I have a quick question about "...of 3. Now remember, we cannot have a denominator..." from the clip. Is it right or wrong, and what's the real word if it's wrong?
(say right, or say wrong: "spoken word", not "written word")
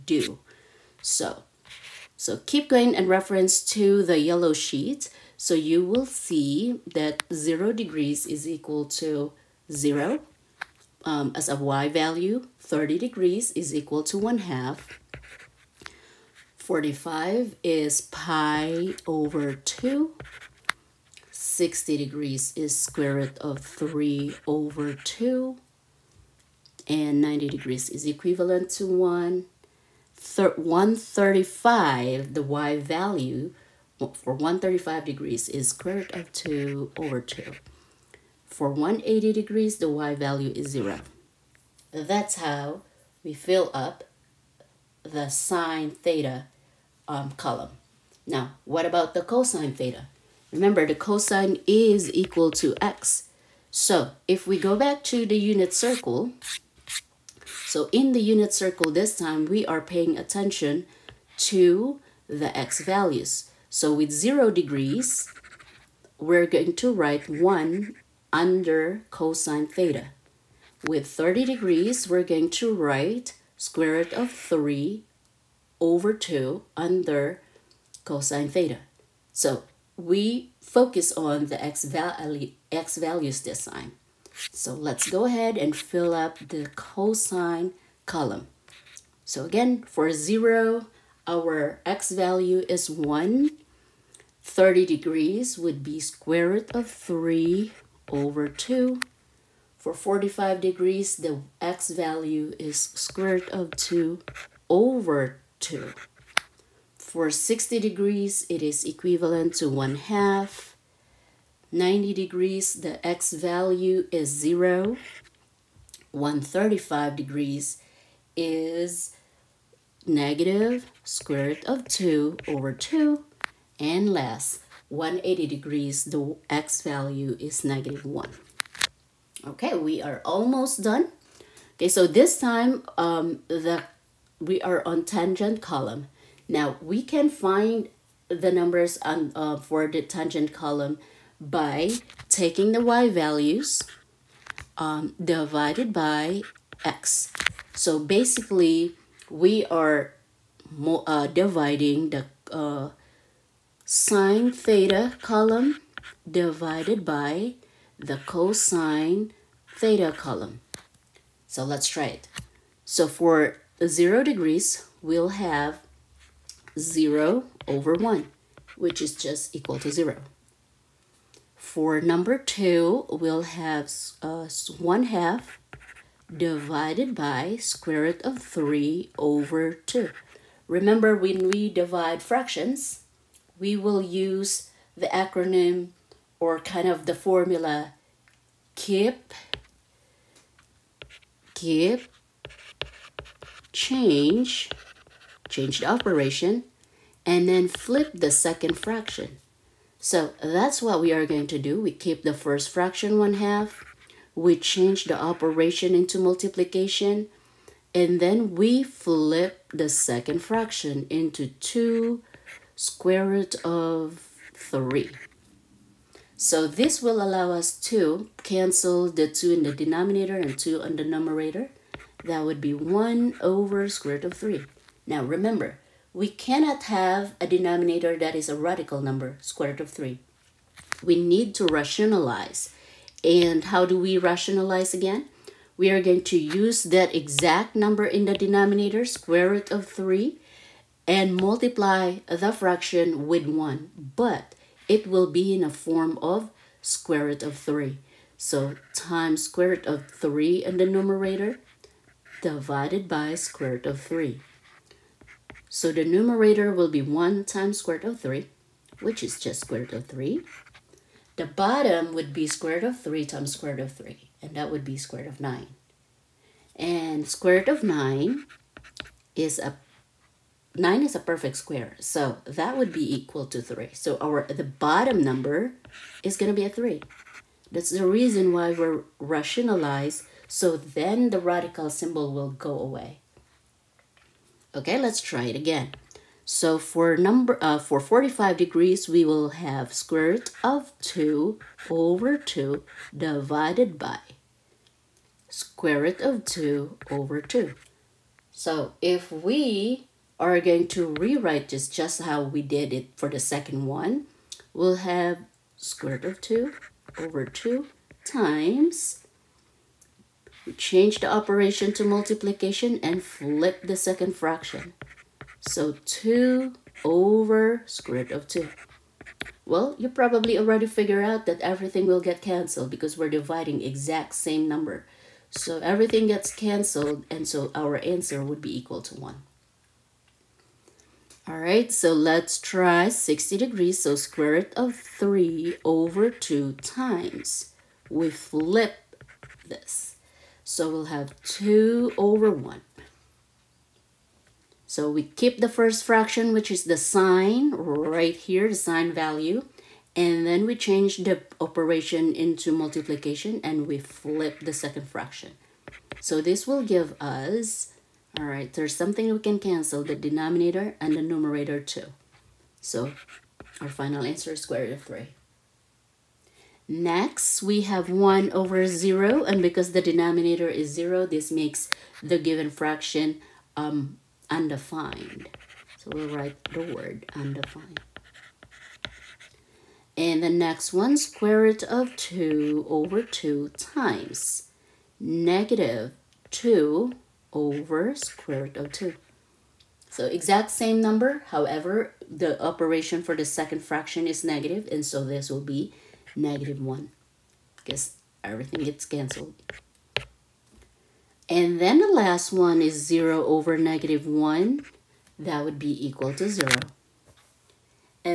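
right.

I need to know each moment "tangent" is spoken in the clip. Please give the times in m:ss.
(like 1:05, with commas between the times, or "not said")
2:15, 2:20.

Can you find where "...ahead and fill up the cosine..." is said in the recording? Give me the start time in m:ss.
1:25.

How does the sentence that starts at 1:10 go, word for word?
With 30 degrees, we're going to write square root of 3 over 2 under cosine theta.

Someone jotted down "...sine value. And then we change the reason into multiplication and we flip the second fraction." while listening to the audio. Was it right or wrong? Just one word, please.
wrong.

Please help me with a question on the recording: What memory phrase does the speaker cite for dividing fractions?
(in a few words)
keep, change, change.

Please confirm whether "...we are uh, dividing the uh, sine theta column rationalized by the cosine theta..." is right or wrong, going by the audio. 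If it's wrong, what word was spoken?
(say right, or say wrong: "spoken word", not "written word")
wrong: "divided", not "rationalized".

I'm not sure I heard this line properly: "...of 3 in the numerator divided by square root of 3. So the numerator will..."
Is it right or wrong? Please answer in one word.
right.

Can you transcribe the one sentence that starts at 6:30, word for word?
So exact same number, however, the operation for the second fraction is negative, and so this will be negative 1.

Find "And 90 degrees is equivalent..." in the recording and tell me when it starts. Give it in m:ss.
0:26.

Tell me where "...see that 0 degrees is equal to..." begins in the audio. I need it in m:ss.
0:06.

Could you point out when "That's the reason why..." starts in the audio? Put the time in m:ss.
4:37.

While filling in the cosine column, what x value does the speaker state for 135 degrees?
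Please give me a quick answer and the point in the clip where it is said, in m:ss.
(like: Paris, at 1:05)
negative square root of 2 over 2, at 2:00.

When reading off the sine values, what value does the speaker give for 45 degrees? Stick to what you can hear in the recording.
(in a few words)
pi over 2.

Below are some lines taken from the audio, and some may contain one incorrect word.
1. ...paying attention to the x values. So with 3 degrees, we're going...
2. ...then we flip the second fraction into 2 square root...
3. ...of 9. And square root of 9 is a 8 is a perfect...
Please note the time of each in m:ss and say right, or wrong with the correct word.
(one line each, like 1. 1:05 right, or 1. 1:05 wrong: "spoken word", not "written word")
1. 0:59 wrong: "0", not "3"
2. 3:28 right
3. 4:25 wrong: "9", not "8".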